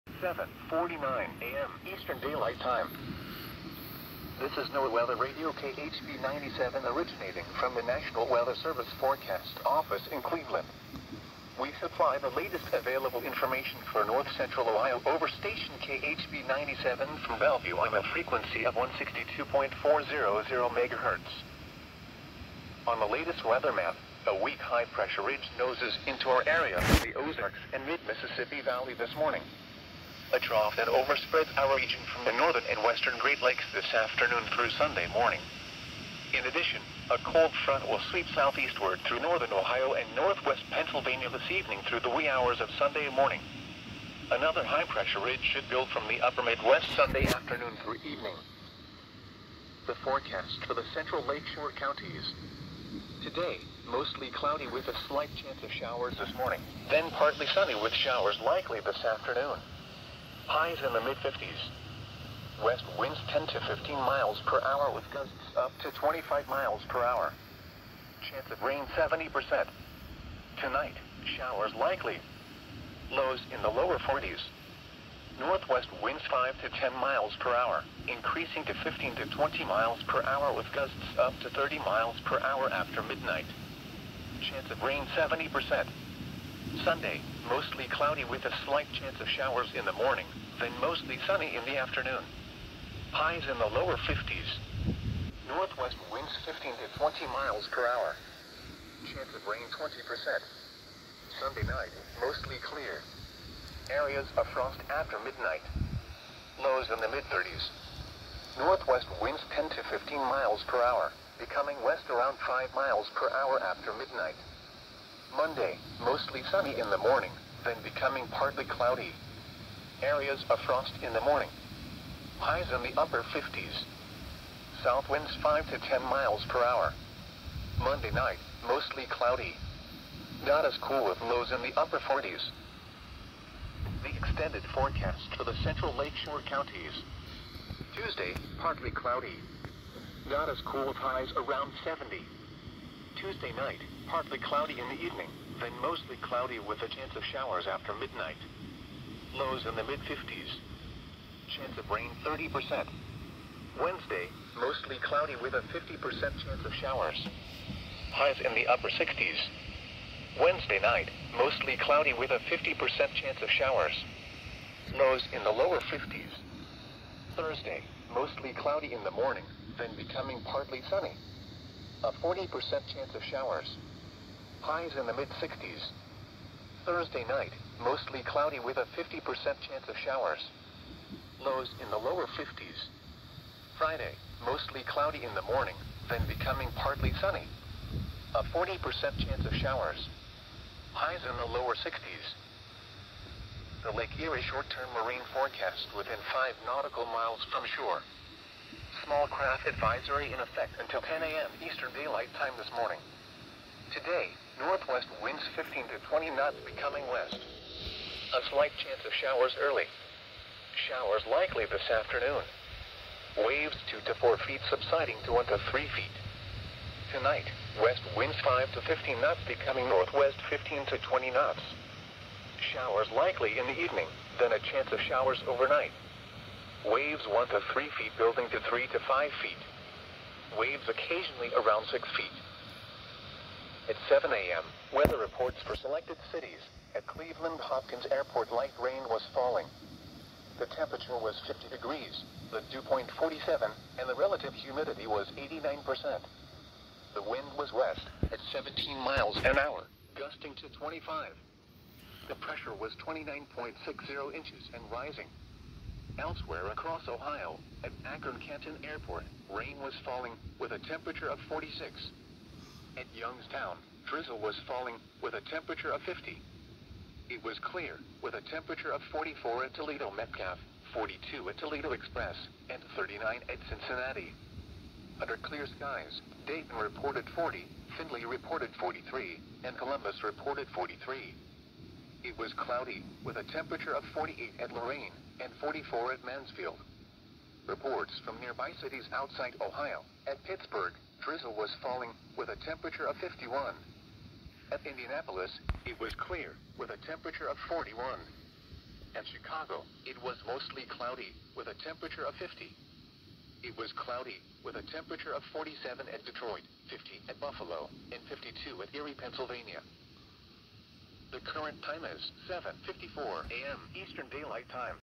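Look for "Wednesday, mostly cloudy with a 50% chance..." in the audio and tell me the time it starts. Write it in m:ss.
2:33.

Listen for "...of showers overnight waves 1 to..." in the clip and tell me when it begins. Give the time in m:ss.
3:44.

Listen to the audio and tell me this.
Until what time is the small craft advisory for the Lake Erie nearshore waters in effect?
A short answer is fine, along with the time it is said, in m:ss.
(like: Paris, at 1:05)
10 a.m., at 3:21.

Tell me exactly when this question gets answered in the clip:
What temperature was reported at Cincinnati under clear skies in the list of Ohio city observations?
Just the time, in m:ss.
4:32.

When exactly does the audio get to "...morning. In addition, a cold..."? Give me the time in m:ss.
0:35.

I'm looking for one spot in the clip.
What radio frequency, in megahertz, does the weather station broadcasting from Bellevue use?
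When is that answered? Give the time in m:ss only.
0:18.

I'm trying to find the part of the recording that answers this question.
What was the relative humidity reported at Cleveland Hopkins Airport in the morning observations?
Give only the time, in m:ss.
4:05.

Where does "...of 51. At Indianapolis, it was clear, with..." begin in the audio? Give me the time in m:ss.
4:53.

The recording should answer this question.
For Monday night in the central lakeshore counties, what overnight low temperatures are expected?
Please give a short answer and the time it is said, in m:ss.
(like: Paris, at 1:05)
upper 40s, at 2:11.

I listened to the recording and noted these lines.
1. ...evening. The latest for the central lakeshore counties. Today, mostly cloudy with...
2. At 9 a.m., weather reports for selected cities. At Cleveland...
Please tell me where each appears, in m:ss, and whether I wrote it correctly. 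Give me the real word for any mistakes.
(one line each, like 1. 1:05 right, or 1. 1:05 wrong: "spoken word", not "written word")
1. 0:48 wrong: "forecast", not "latest"
2. 3:53 wrong: "7", not "9".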